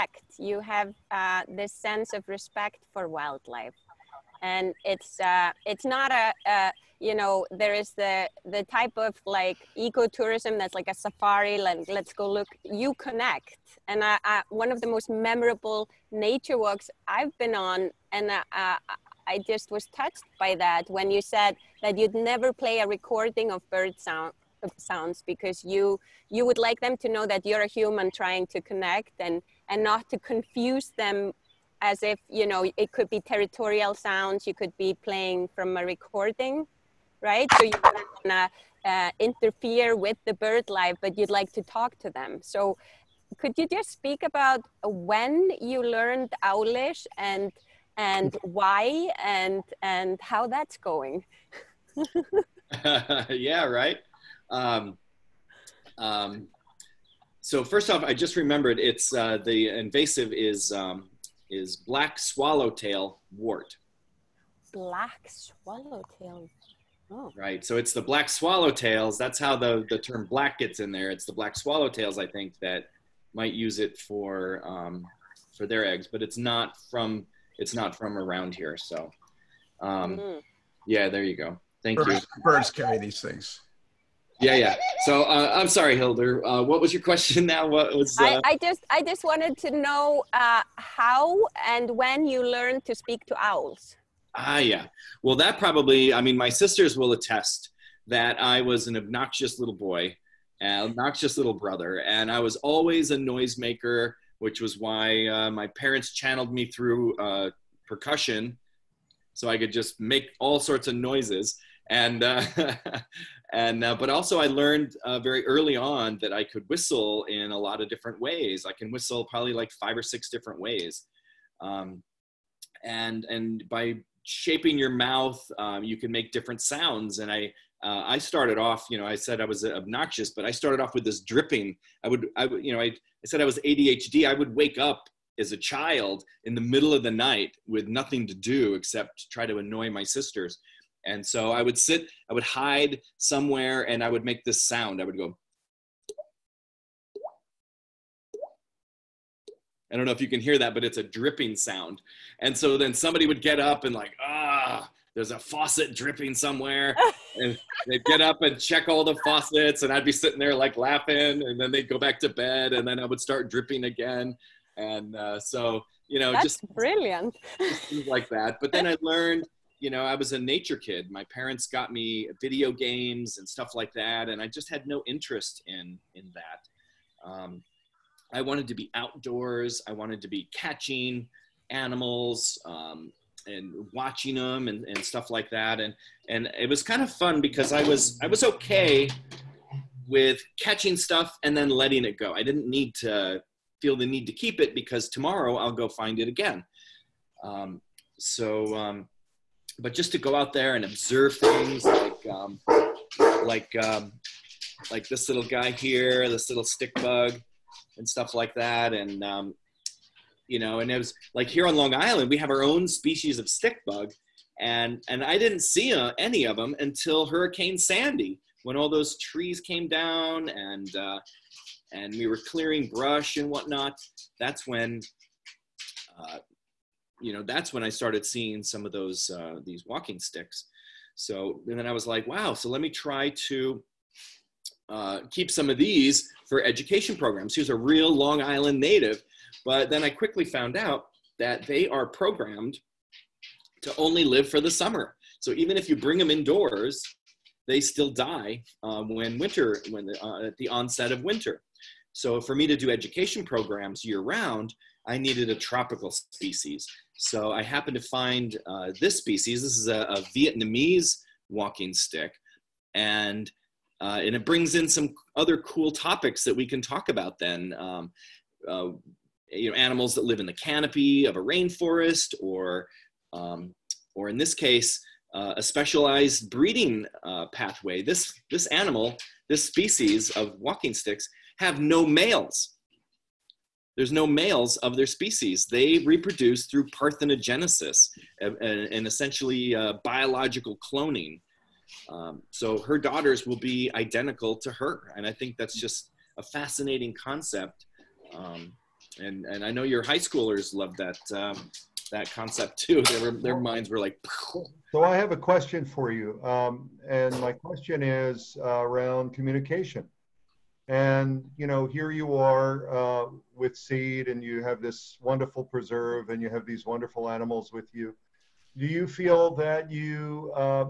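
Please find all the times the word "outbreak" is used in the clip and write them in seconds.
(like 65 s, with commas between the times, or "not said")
not said.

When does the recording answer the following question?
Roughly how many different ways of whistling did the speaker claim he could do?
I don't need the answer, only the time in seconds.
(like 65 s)
119 s.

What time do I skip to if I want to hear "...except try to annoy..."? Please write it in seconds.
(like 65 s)
138 s.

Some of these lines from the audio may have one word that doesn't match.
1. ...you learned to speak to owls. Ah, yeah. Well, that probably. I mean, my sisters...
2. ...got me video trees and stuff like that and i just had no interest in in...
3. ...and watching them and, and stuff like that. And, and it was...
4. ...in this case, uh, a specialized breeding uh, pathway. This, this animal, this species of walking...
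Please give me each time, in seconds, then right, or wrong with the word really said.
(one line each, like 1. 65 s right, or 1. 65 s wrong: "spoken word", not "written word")
1. 92 s right
2. 171 s wrong: "games", not "trees"
3. 183 s right
4. 274 s right.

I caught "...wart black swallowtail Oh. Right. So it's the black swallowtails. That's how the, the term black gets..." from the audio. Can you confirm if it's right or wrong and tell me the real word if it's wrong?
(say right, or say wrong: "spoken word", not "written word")
right.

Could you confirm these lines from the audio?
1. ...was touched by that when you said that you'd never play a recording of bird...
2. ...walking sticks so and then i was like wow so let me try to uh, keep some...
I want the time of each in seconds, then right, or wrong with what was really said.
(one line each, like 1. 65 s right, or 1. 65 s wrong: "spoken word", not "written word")
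1. 19 s right
2. 229 s right.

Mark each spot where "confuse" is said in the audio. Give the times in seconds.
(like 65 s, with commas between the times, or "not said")
30 s.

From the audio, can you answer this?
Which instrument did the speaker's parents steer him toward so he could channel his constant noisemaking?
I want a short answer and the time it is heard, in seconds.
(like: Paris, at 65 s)
Percussion, at 107 s.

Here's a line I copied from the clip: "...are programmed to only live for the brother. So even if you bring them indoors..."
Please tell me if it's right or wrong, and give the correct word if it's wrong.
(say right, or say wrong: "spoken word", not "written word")
wrong: "summer", not "brother".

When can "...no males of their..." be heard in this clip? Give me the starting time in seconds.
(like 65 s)
284 s.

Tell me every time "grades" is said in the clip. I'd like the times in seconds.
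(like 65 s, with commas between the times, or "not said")
not said.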